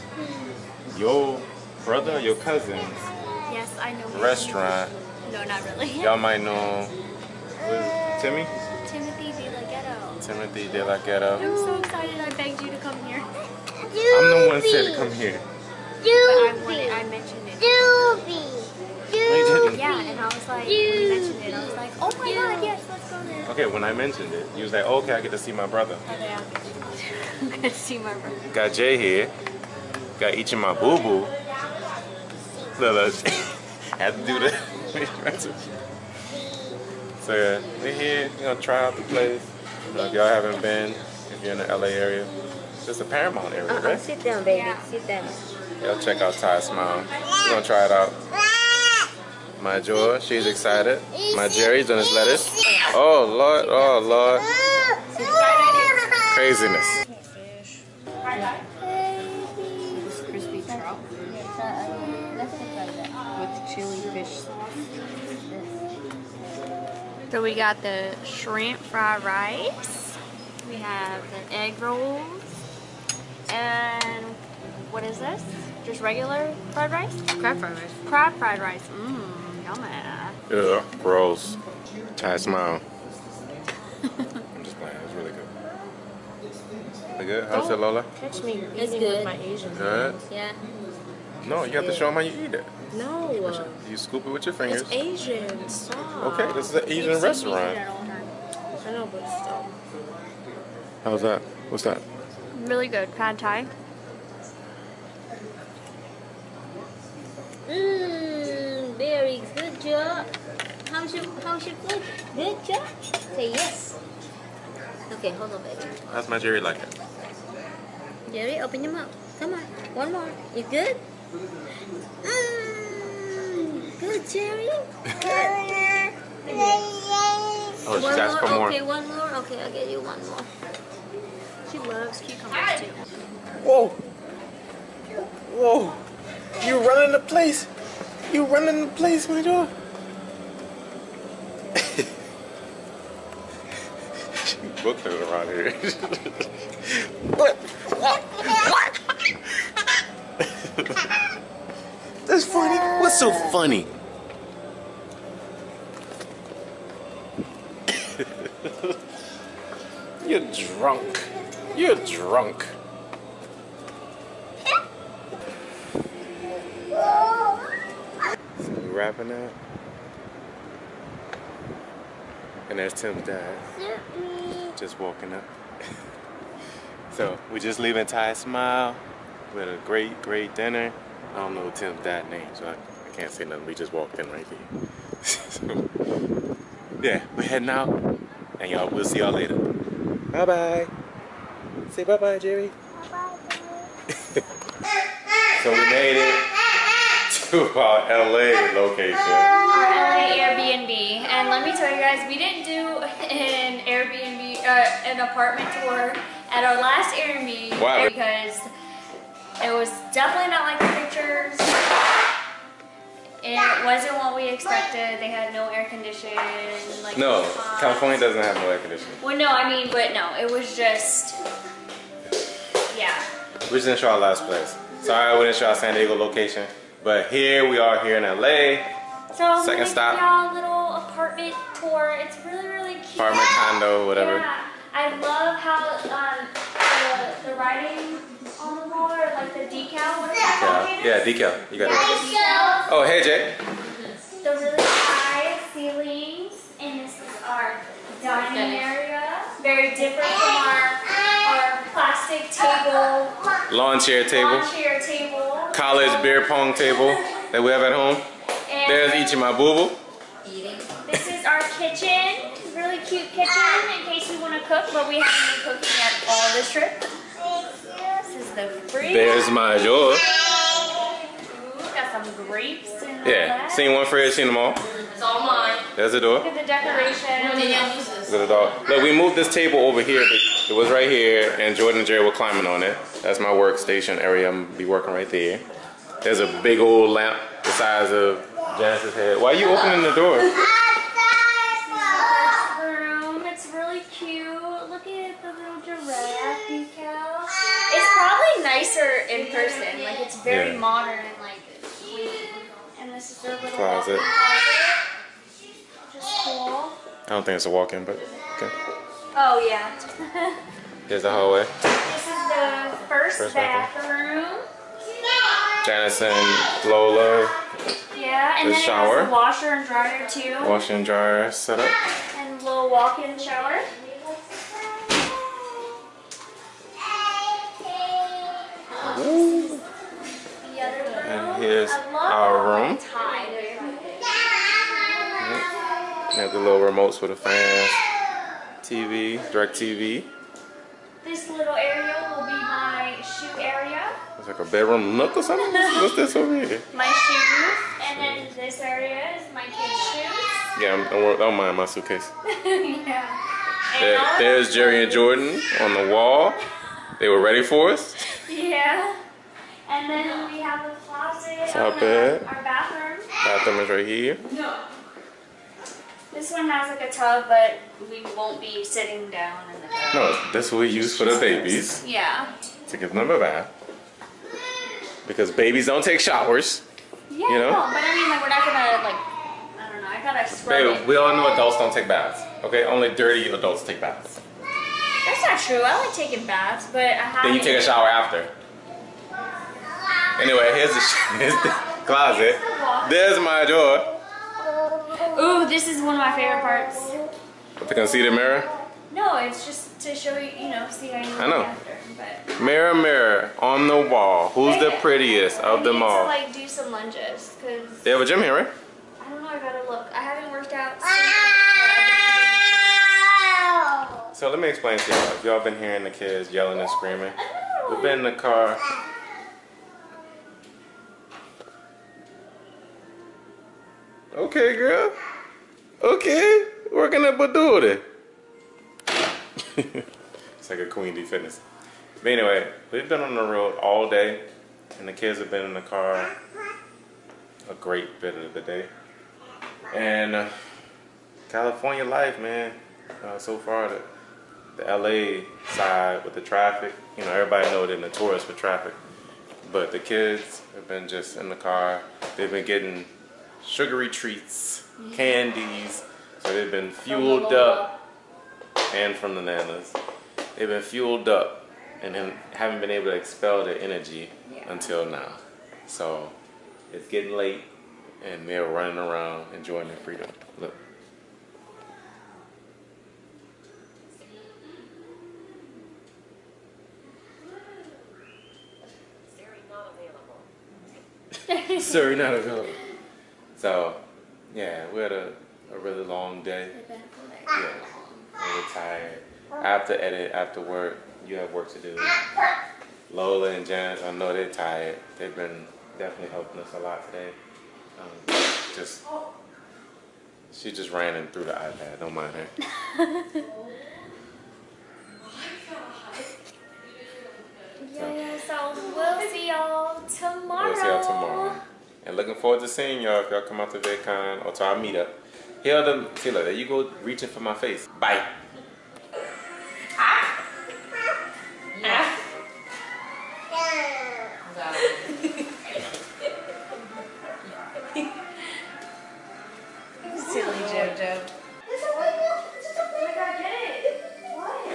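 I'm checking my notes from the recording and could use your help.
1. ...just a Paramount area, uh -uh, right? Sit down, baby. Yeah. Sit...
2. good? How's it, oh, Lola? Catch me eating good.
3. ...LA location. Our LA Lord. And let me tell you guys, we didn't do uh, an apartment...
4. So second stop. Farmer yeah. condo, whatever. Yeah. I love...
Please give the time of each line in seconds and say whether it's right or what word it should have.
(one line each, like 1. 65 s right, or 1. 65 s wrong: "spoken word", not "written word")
1. 42 s right
2. 87 s right
3. 198 s wrong: "Airbnb", not "Lord"
4. 229 s right.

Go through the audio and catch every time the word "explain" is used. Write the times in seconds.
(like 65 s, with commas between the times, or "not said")
414 s.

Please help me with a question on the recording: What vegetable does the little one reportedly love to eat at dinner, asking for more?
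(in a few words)
Cucumbers.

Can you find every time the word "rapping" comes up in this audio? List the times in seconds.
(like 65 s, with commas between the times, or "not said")
168 s.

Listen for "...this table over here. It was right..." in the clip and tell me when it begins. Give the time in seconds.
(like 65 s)
279 s.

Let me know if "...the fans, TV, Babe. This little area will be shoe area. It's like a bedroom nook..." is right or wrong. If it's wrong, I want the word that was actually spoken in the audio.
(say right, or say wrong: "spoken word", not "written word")
wrong: "DirecTV", not "Babe".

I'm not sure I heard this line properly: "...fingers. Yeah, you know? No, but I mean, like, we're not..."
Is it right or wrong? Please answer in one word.
wrong.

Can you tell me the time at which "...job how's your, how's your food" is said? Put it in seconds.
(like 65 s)
109 s.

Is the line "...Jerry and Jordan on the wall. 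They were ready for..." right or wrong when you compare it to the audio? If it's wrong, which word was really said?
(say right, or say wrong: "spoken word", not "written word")
right.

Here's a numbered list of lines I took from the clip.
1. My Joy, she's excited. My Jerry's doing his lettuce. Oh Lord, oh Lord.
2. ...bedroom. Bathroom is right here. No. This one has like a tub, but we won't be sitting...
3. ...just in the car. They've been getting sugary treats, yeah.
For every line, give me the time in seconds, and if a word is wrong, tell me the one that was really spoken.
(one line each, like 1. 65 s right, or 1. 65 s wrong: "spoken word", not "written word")
1. 49 s right
2. 362 s wrong: "bathroom", not "bedroom"
3. 451 s right.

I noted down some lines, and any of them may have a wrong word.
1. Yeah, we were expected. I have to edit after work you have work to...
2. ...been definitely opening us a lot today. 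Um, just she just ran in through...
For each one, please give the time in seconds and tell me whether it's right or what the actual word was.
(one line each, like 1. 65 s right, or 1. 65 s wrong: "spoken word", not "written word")
1. 486 s wrong: "tired", not "expected"
2. 495 s wrong: "helping", not "opening".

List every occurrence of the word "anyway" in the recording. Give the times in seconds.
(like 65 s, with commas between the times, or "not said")
390 s, 432 s.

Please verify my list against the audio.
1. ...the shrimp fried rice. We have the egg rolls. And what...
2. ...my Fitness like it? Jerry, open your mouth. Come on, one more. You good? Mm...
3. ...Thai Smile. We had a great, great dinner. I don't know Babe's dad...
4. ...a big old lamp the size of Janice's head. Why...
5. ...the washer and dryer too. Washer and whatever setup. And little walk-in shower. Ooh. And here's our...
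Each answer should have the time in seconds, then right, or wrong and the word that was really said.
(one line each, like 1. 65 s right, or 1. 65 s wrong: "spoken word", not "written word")
1. 67 s right
2. 116 s wrong: "Jerry", not "Fitness"
3. 178 s wrong: "Tim", not "Babe"
4. 286 s right
5. 319 s wrong: "dryer", not "whatever".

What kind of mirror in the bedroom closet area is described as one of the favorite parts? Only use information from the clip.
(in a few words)
Concealer mirror.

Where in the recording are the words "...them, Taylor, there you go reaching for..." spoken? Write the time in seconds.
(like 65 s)
515 s.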